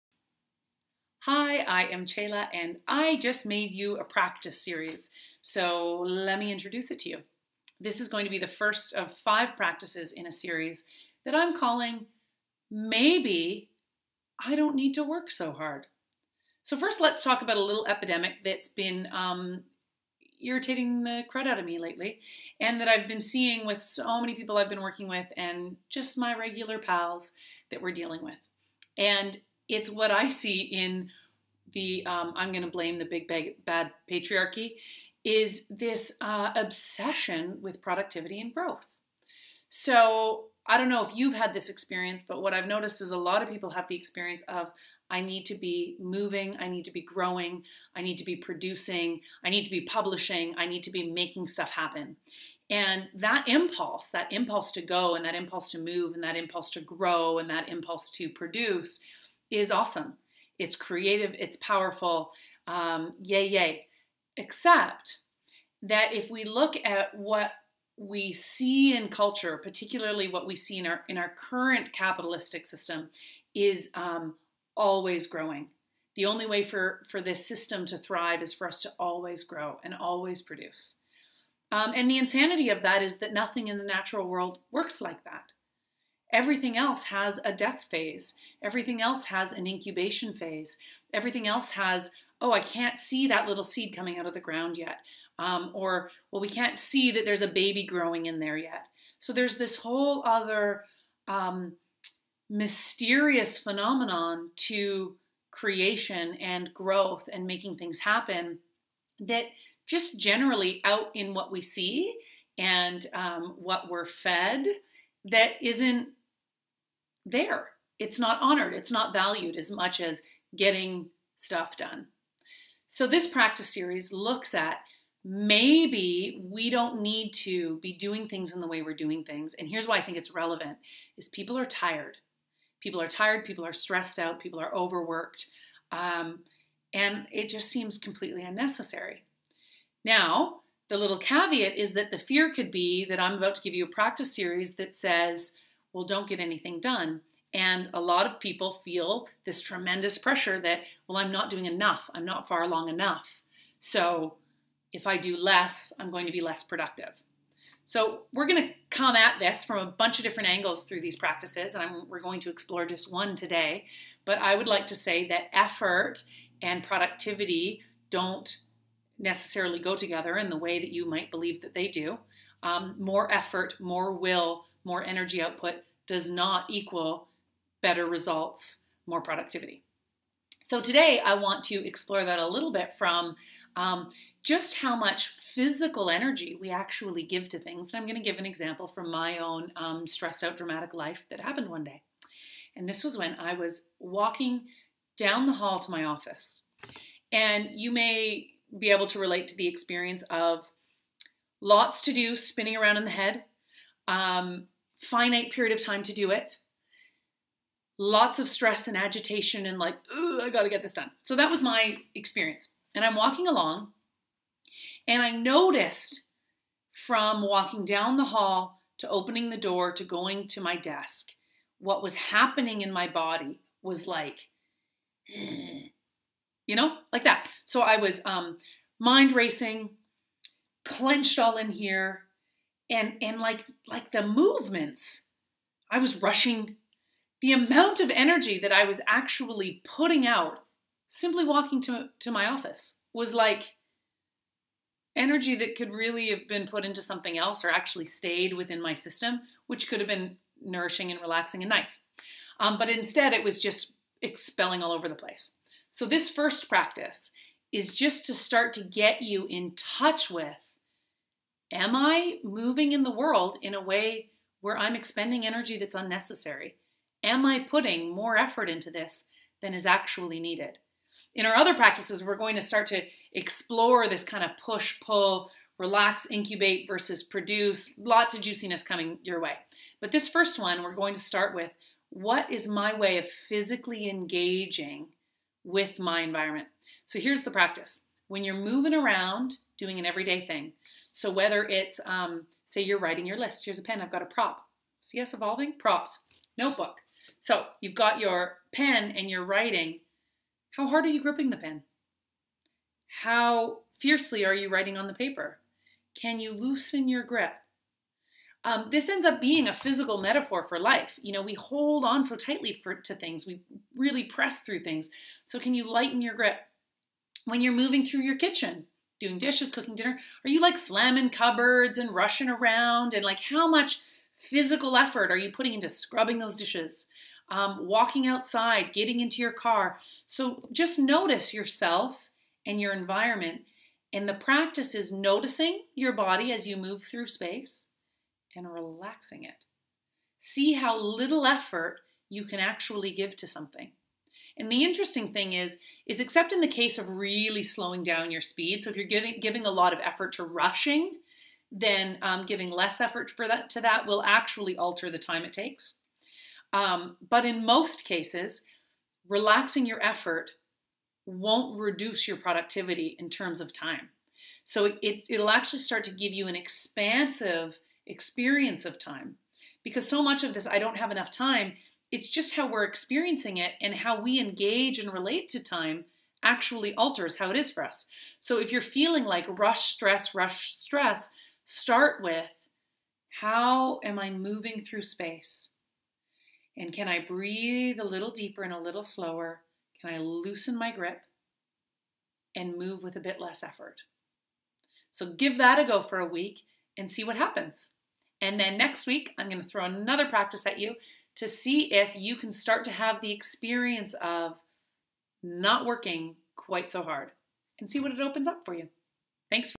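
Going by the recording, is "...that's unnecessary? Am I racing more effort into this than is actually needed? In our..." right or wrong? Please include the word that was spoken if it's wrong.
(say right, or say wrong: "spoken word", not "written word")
wrong: "putting", not "racing".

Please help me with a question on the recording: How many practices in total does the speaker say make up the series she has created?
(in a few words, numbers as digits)
5.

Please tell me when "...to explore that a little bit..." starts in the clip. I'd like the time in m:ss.
3:01.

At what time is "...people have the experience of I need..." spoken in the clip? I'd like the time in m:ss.
0:43.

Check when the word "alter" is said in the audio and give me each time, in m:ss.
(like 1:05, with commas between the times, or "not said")
5:54, 6:16.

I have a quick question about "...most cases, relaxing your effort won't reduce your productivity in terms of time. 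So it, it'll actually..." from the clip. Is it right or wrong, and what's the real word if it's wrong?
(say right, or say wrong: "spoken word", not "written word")
right.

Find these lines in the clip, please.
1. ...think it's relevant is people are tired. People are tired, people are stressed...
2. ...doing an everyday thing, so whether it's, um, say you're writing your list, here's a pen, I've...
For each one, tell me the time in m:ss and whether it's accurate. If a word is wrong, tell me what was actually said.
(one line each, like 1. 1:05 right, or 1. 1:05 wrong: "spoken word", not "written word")
1. 2:10 right
2. 4:49 right.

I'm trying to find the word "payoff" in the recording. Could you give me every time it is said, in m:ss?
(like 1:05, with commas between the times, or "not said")
not said.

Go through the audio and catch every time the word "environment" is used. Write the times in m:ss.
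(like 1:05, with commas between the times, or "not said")
4:46, 5:32.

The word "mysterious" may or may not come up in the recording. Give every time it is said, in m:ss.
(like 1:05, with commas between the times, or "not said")
1:42.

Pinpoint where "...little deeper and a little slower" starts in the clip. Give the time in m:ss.
6:28.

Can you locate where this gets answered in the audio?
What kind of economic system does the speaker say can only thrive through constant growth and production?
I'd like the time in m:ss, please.
1:11.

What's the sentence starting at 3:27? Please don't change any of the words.
Lots of stress and agitation and like, I gotta get this done.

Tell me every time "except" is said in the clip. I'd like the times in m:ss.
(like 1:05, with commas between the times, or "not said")
1:04, 5:46.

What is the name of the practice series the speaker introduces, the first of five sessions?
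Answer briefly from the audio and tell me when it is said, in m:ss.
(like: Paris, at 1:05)
Maybe I Don't Need to Work So Hard, at 0:12.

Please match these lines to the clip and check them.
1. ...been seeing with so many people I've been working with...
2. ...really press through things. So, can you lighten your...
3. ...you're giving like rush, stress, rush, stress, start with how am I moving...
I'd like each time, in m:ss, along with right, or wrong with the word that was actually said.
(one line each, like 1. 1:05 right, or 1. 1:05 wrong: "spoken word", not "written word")
1. 0:23 right
2. 5:13 right
3. 6:18 wrong: "feeling", not "giving".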